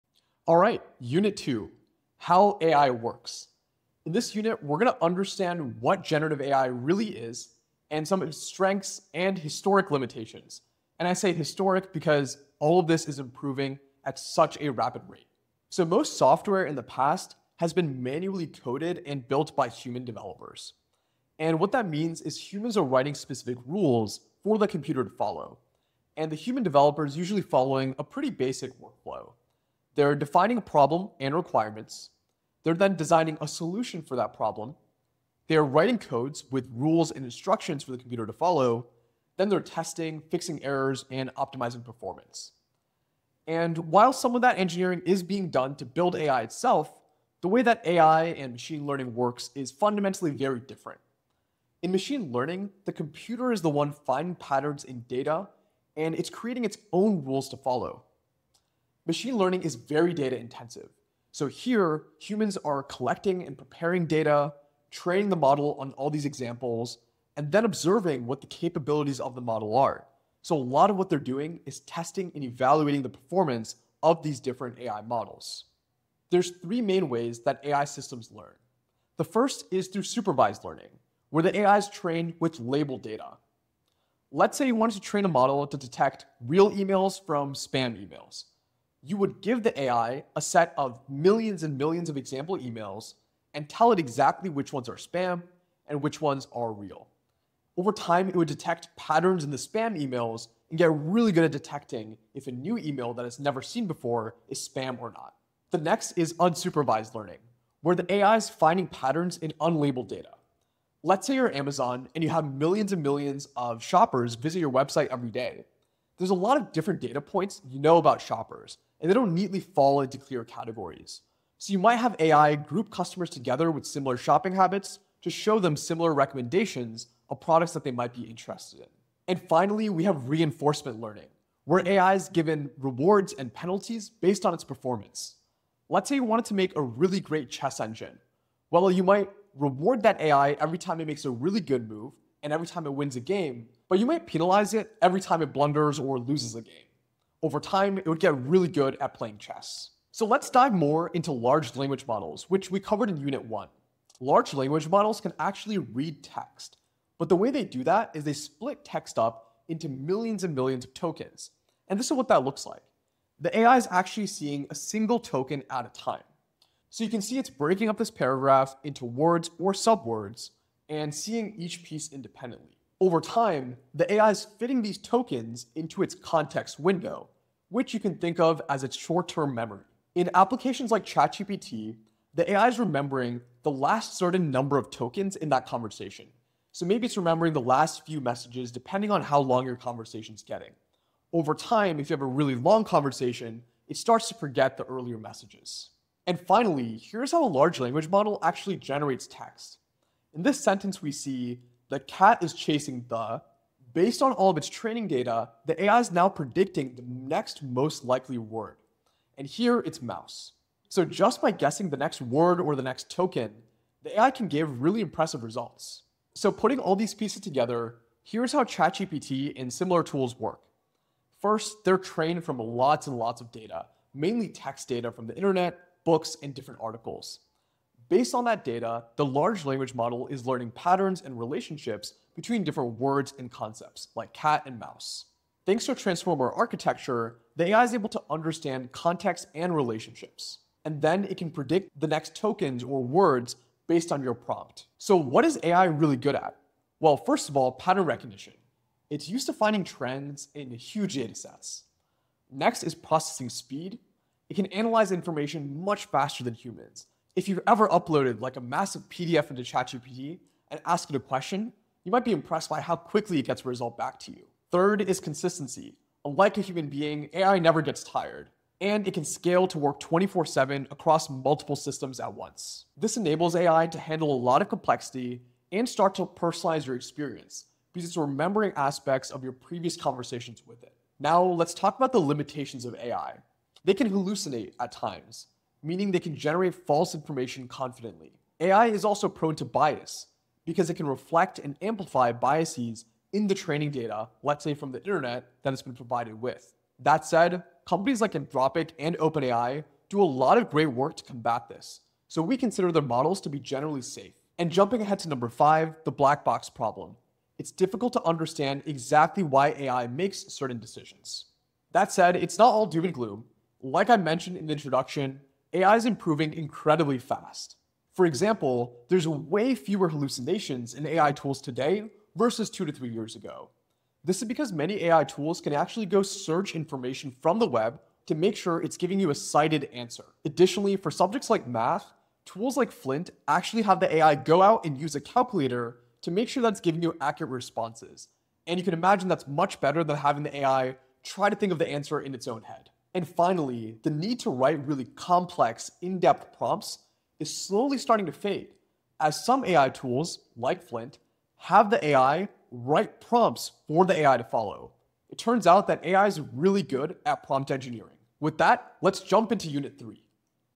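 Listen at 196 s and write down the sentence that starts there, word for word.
And finally, here's how a large language model actually generates text.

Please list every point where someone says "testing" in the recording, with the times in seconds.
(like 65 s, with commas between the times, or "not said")
39 s, 71 s.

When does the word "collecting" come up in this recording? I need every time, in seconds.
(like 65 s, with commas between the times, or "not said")
62 s.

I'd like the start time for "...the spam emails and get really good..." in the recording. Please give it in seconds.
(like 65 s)
99 s.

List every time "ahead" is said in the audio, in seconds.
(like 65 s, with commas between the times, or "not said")
305 s.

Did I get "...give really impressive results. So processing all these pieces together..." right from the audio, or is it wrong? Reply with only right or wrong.
wrong.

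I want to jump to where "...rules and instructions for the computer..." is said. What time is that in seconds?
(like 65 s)
36 s.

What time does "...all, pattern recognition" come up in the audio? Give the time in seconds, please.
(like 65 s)
247 s.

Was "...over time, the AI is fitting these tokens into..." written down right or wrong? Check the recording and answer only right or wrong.
right.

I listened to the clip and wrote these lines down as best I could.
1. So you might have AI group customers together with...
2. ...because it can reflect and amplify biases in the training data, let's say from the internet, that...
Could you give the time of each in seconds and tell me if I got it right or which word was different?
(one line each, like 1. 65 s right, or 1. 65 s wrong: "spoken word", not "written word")
1. 121 s right
2. 290 s right.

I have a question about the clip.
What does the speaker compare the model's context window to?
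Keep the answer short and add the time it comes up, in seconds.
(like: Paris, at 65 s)
short-term memory, at 178 s.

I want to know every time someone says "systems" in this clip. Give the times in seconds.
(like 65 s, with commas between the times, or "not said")
77 s, 271 s.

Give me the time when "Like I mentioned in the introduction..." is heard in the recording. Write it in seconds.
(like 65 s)
313 s.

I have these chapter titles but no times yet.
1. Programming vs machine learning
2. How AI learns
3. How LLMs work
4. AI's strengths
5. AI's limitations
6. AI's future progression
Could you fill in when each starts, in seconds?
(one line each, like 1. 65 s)
1. 16 s
2. 76 s
3. 150 s
4. 245 s
5. 281 s
6. 312 s.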